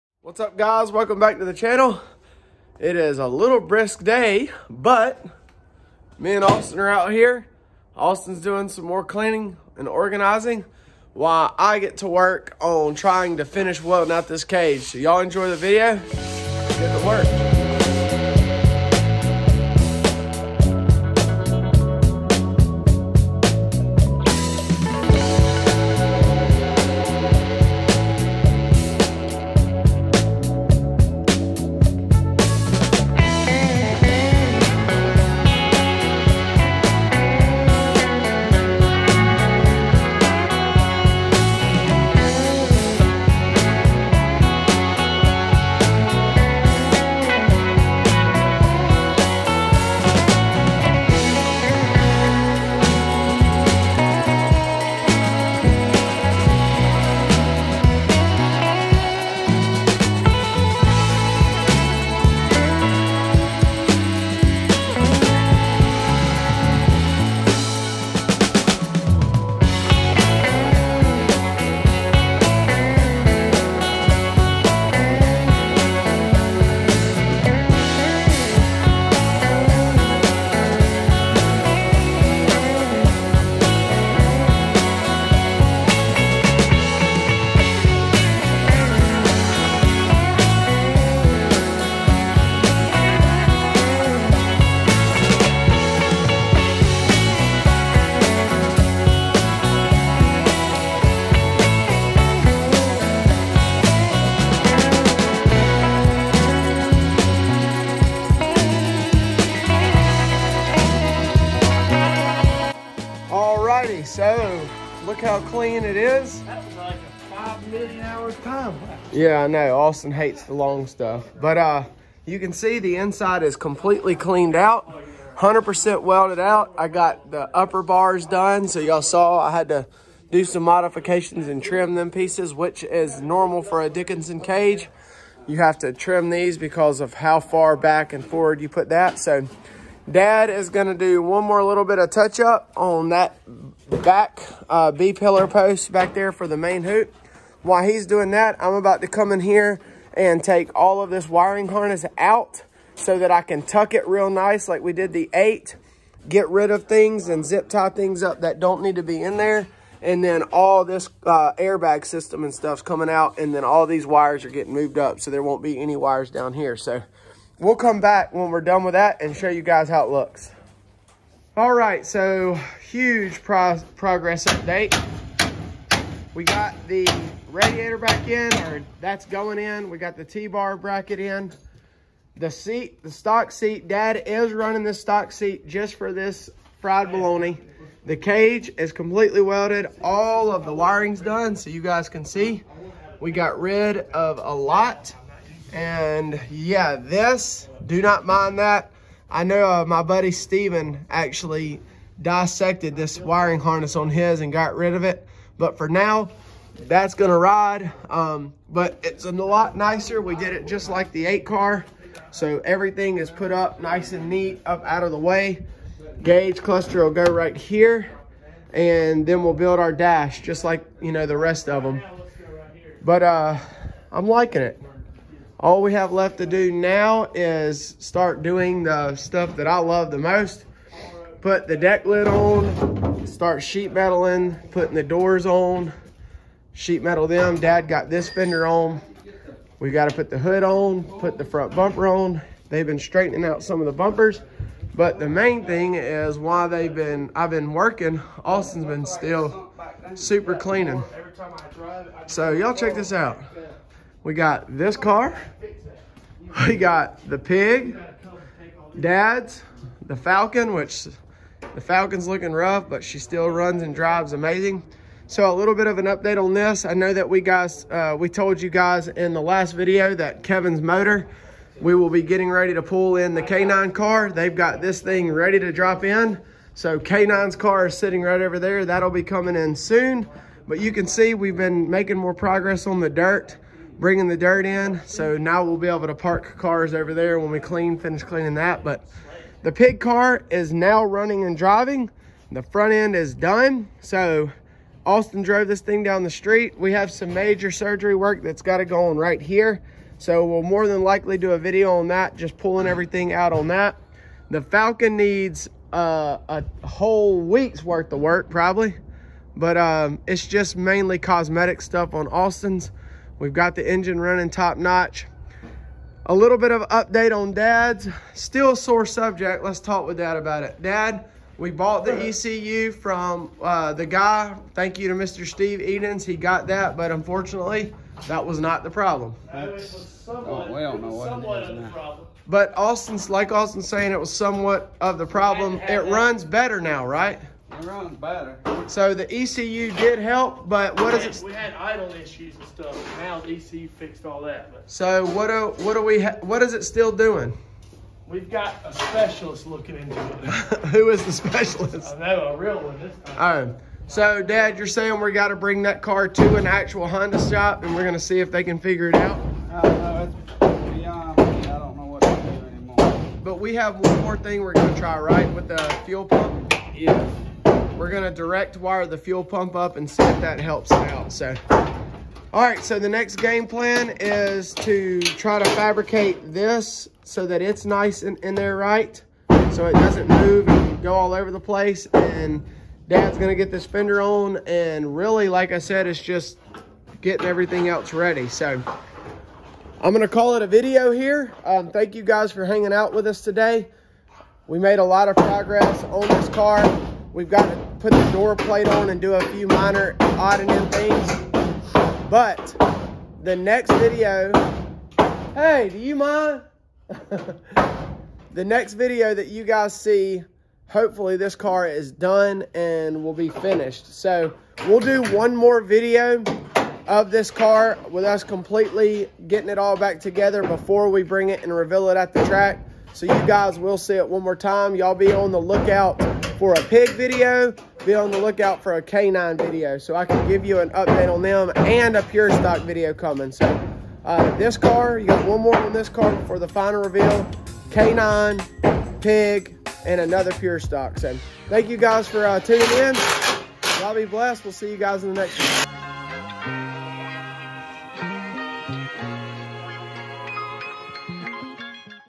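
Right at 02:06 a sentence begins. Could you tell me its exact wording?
I got the upper bars done.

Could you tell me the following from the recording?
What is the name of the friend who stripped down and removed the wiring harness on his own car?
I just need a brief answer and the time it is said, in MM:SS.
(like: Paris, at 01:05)
Steven, at 03:20.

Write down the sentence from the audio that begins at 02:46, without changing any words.
So we'll come back when we're done with that and show you guys how it looks.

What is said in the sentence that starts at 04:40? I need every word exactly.
But you can see we've been making more progress on the dirt bringing the dirt in.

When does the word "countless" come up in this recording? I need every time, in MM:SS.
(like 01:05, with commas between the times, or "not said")
not said.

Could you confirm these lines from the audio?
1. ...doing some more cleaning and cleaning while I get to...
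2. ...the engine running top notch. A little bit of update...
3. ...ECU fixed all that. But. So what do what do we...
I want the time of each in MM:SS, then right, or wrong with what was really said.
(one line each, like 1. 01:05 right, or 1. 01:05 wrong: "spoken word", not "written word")
1. 00:08 wrong: "organizing", not "cleaning"
2. 05:13 right
3. 05:43 right.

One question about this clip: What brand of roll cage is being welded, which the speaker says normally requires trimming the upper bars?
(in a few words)
Dickinson.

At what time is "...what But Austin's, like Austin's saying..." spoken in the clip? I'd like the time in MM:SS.
05:31.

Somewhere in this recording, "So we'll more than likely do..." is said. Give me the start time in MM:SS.
05:00.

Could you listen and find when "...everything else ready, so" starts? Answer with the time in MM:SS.
06:27.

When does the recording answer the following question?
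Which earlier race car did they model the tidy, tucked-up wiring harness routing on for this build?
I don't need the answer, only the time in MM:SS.
02:35.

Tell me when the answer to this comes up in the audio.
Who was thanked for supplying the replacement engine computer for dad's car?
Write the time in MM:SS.
05:25.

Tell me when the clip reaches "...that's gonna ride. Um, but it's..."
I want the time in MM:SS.
03:26.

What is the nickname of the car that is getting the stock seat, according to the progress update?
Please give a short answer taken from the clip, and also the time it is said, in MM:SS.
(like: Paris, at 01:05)
Fried bologna, at 03:06.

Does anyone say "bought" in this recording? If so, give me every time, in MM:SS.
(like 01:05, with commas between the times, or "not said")
05:21.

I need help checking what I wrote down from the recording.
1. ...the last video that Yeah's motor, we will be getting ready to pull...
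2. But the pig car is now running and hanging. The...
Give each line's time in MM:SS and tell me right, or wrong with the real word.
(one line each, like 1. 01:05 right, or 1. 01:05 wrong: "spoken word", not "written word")
1. 04:29 wrong: "Kevin", not "Yeah"
2. 04:48 wrong: "driving", not "hanging".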